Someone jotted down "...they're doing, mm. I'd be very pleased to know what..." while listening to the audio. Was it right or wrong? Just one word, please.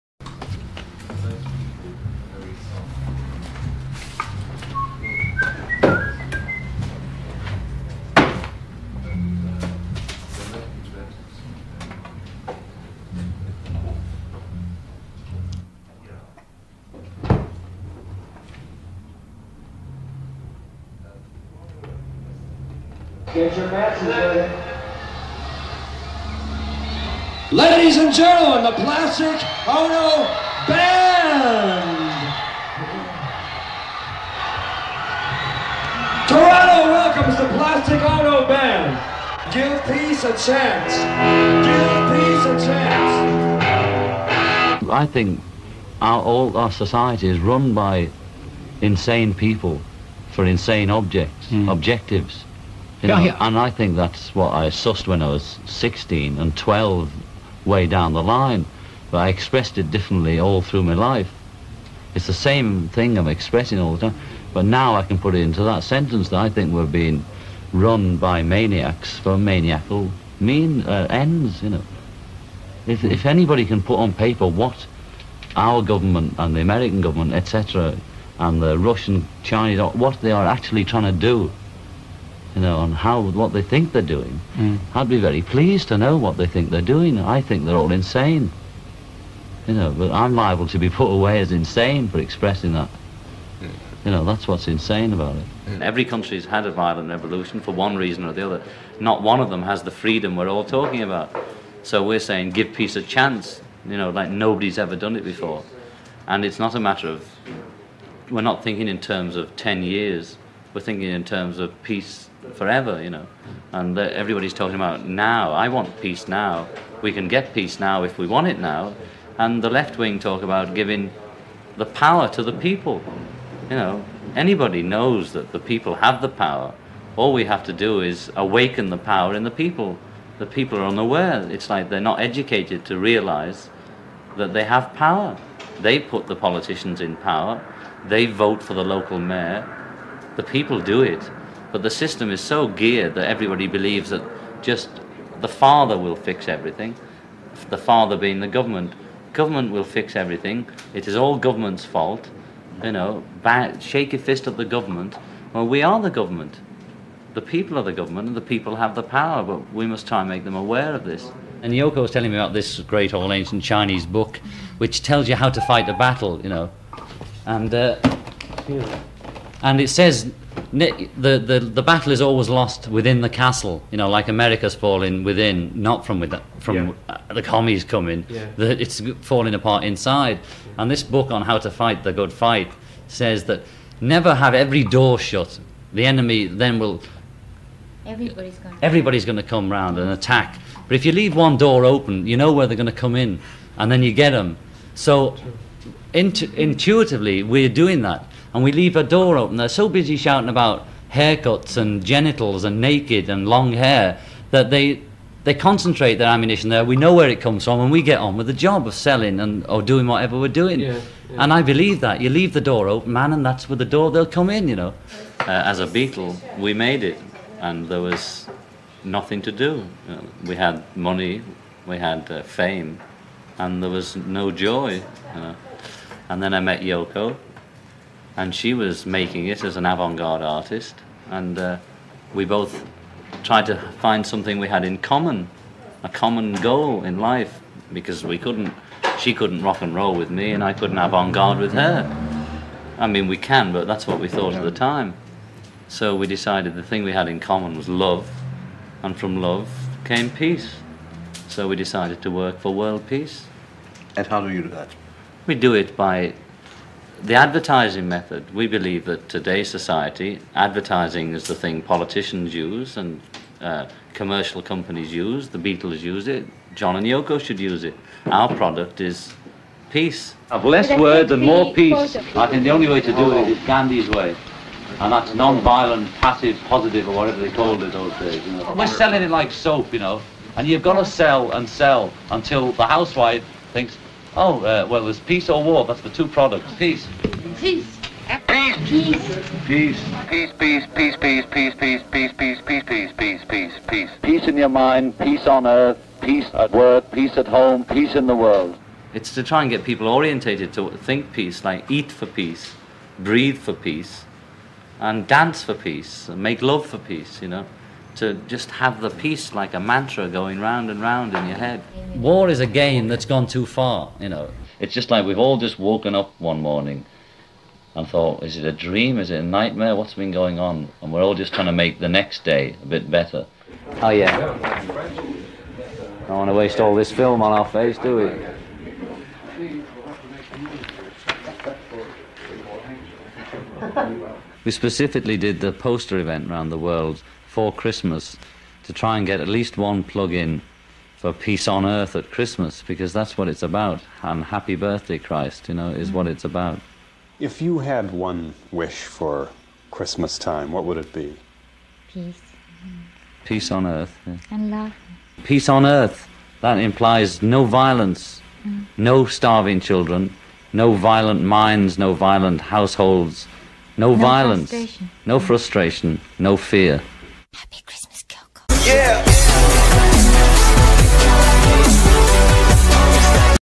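right.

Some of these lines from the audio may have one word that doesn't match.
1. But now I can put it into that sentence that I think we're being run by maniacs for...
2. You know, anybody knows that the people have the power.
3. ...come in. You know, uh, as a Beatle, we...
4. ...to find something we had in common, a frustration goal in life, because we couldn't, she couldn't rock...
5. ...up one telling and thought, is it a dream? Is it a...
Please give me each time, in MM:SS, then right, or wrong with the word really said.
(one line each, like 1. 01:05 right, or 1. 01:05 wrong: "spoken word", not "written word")
1. 01:04 right
2. 02:03 right
3. 03:34 right
4. 03:53 wrong: "common", not "frustration"
5. 05:16 wrong: "morning", not "telling".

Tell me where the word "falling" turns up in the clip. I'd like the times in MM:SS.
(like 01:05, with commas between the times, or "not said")
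02:54, 02:59.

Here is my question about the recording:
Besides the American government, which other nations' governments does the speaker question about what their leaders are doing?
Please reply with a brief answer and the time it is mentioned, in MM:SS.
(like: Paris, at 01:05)
Russian, Chinese, at 01:18.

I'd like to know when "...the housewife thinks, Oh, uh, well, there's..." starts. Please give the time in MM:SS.
04:42.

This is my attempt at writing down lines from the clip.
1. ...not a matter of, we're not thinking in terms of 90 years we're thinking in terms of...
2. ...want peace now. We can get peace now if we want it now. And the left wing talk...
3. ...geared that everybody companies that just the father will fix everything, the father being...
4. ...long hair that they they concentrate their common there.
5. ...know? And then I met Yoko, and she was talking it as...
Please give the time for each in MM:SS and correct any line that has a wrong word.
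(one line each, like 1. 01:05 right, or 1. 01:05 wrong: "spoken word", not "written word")
1. 01:46 wrong: "10", not "90"
2. 01:55 right
3. 02:22 wrong: "believes", not "companies"
4. 03:23 wrong: "ammunition", not "common"
5. 03:45 wrong: "making", not "talking".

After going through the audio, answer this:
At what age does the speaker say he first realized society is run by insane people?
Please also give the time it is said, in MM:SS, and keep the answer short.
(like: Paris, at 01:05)
16, at 00:55.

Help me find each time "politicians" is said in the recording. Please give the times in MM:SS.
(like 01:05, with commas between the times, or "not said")
02:16, 04:21.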